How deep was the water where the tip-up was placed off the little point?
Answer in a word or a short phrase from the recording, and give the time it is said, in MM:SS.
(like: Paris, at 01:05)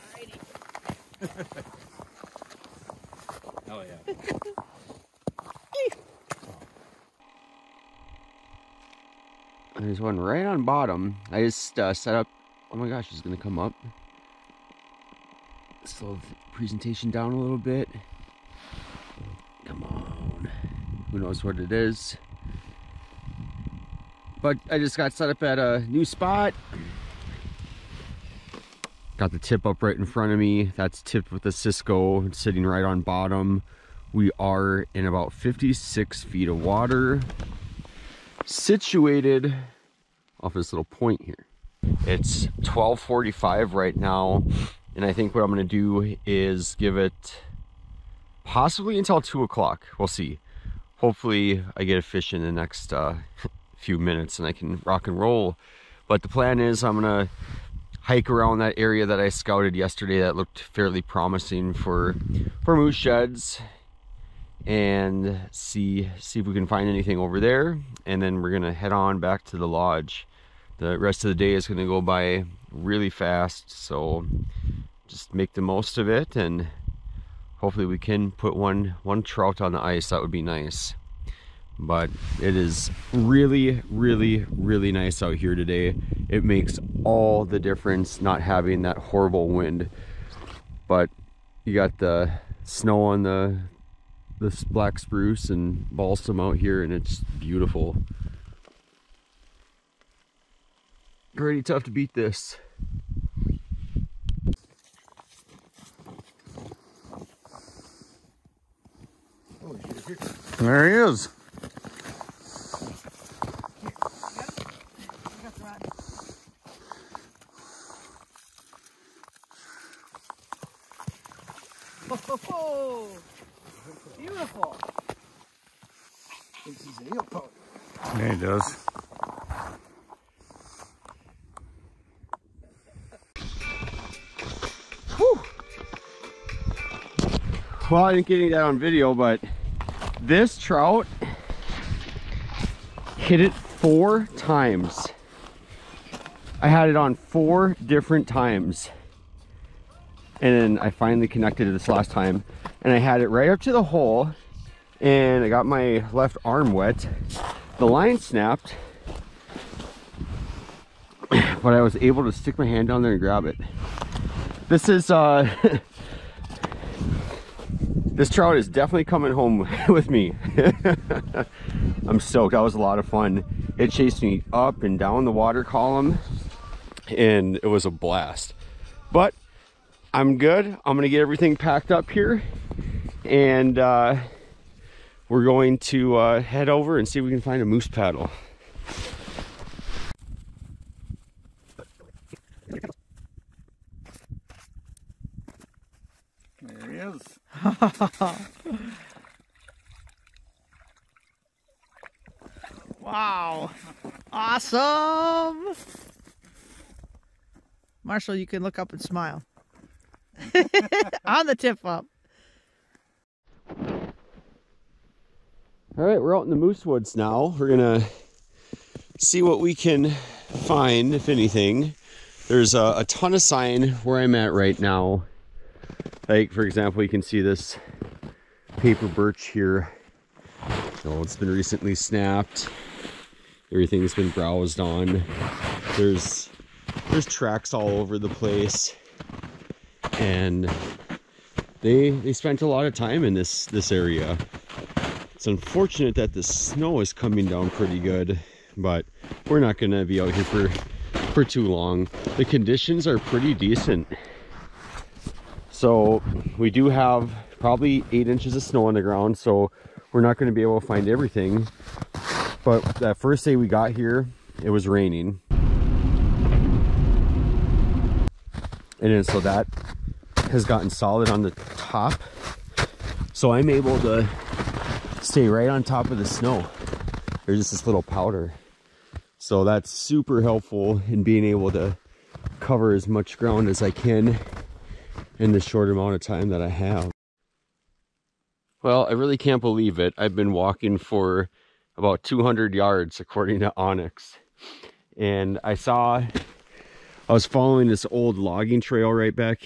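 56 feet, at 00:35.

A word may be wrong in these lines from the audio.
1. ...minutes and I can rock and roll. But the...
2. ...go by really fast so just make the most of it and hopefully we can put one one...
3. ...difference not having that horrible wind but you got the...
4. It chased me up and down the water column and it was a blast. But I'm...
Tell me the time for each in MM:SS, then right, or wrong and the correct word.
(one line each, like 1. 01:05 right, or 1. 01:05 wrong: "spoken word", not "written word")
1. 00:53 right
2. 01:11 right
3. 01:27 right
4. 02:53 right.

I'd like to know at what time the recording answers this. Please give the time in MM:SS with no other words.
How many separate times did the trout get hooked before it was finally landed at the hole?
02:27.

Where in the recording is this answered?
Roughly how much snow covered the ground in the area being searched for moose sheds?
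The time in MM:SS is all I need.
04:18.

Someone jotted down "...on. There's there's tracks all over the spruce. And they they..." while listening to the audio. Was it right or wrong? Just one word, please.
wrong.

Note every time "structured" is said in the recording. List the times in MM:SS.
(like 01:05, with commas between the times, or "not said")
not said.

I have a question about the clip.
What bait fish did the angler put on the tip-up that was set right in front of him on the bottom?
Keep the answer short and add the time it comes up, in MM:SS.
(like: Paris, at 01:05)
Cisco, at 00:31.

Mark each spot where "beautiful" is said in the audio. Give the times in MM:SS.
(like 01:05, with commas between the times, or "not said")
01:37, 02:04.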